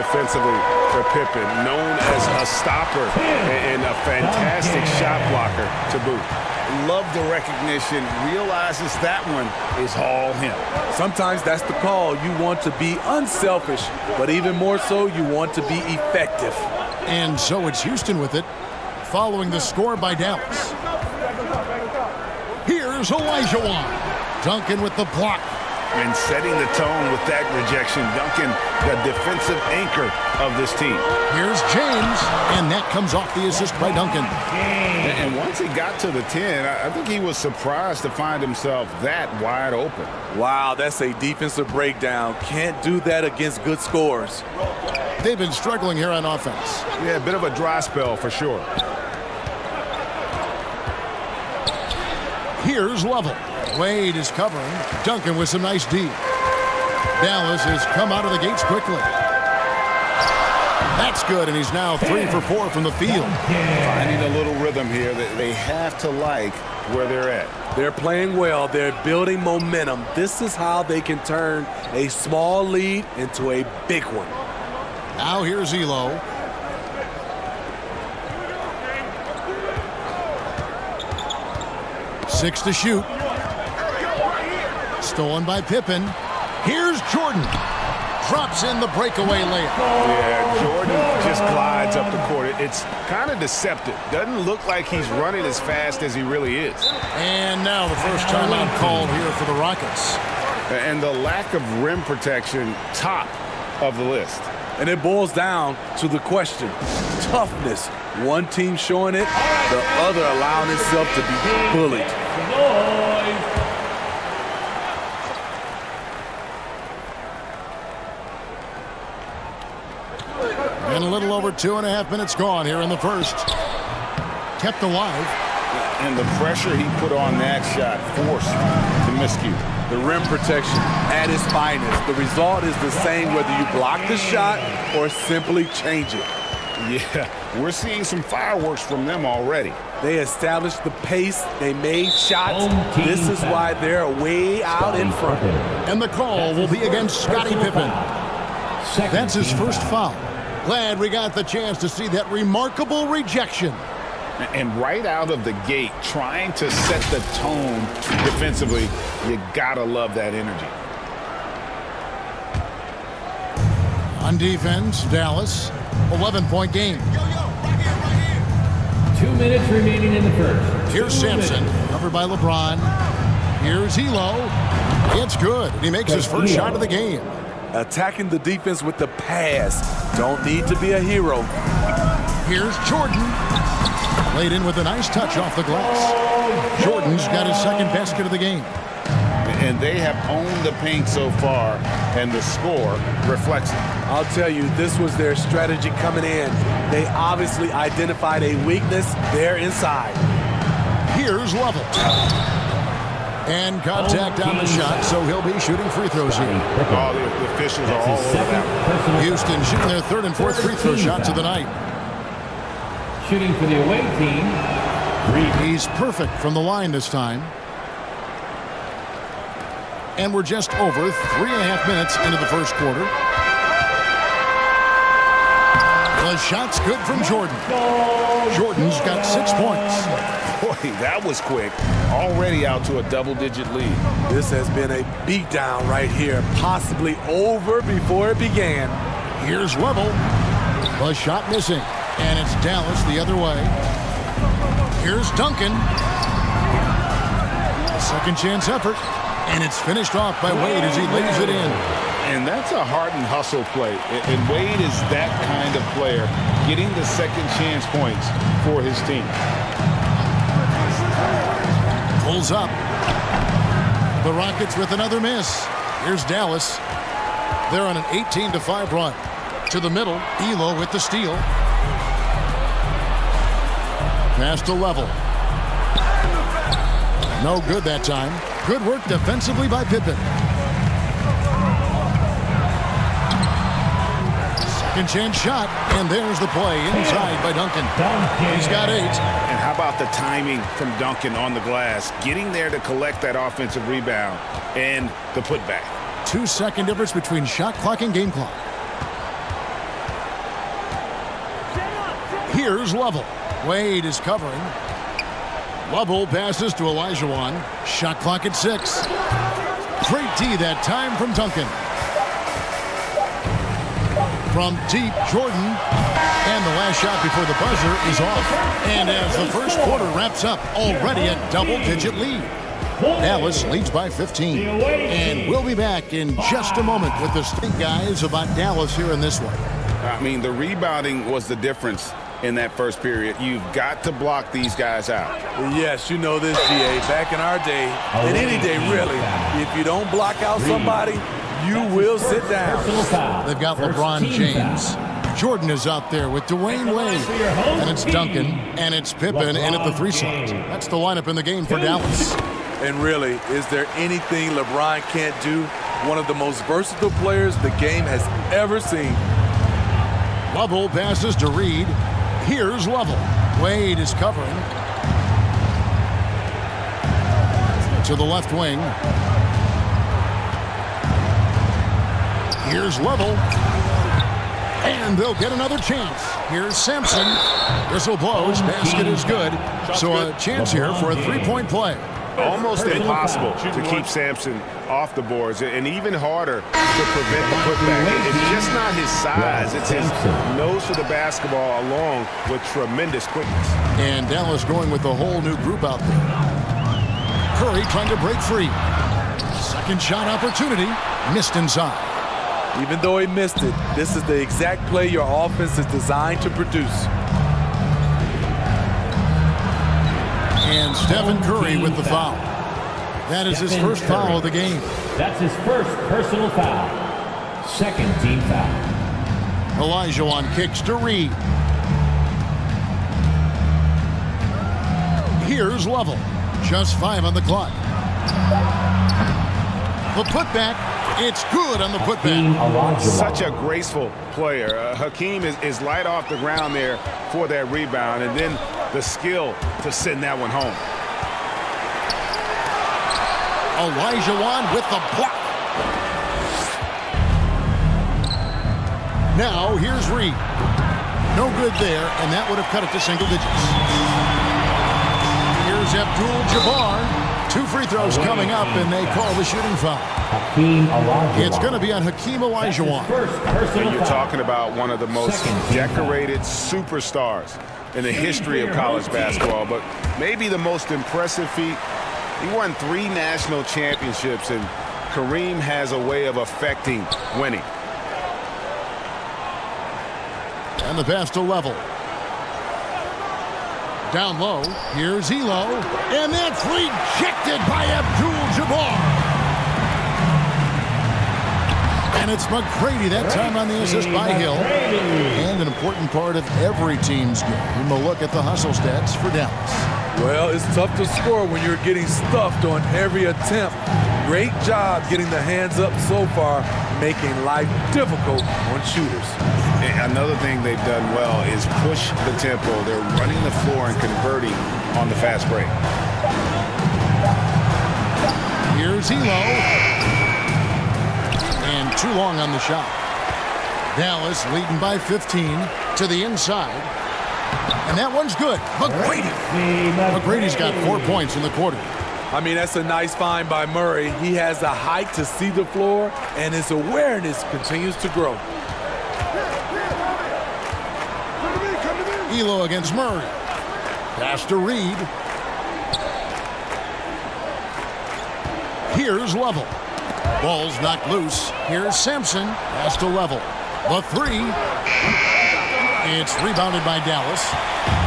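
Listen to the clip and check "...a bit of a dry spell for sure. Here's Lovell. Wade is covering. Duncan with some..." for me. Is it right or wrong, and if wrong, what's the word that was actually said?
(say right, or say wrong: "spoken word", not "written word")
right.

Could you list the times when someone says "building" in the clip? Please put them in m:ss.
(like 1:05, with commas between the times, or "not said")
1:09.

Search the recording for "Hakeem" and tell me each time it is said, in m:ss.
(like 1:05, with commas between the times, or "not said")
7:14, 7:42.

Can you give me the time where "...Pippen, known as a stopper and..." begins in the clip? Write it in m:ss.
0:01.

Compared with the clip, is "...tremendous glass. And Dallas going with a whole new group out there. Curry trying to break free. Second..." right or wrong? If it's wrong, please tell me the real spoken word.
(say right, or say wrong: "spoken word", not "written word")
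wrong: "quickness", not "glass".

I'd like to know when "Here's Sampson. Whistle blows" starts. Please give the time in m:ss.
6:16.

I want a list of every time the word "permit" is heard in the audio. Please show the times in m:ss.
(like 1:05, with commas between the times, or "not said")
not said.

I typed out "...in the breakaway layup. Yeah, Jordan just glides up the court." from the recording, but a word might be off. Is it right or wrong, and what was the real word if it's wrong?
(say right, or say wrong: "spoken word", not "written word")
right.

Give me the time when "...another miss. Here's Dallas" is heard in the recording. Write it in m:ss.
4:24.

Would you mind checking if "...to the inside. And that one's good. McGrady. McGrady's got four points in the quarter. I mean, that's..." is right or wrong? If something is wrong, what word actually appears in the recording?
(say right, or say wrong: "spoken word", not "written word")
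right.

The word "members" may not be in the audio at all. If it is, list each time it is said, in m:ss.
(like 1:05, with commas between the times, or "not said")
not said.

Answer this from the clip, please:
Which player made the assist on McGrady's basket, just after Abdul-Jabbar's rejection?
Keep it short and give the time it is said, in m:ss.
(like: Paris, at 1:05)
Hill, at 8:13.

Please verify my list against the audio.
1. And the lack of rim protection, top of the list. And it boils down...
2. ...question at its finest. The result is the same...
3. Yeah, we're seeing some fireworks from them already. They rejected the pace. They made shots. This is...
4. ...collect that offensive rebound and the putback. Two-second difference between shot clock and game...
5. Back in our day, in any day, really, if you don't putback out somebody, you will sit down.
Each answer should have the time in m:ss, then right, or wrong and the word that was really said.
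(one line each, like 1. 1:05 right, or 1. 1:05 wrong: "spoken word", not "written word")
1. 1:40 right
2. 2:10 wrong: "protection", not "question"
3. 2:16 wrong: "established", not "rejected"
4. 4:52 right
5. 5:37 wrong: "block", not "putback".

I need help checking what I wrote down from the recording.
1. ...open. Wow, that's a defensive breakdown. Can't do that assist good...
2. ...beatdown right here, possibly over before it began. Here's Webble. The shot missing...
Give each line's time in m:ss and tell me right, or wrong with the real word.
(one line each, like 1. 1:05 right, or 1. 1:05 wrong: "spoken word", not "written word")
1. 0:39 wrong: "against", not "assist"
2. 3:55 right.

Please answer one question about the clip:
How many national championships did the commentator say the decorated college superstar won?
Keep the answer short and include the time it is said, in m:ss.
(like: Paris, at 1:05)
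3, at 7:52.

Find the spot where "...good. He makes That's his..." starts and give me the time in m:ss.
2:55.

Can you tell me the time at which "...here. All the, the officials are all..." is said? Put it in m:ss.
3:26.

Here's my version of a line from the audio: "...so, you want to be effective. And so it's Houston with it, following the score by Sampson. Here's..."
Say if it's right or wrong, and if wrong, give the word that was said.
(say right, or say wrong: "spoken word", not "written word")
wrong: "Dallas", not "Sampson".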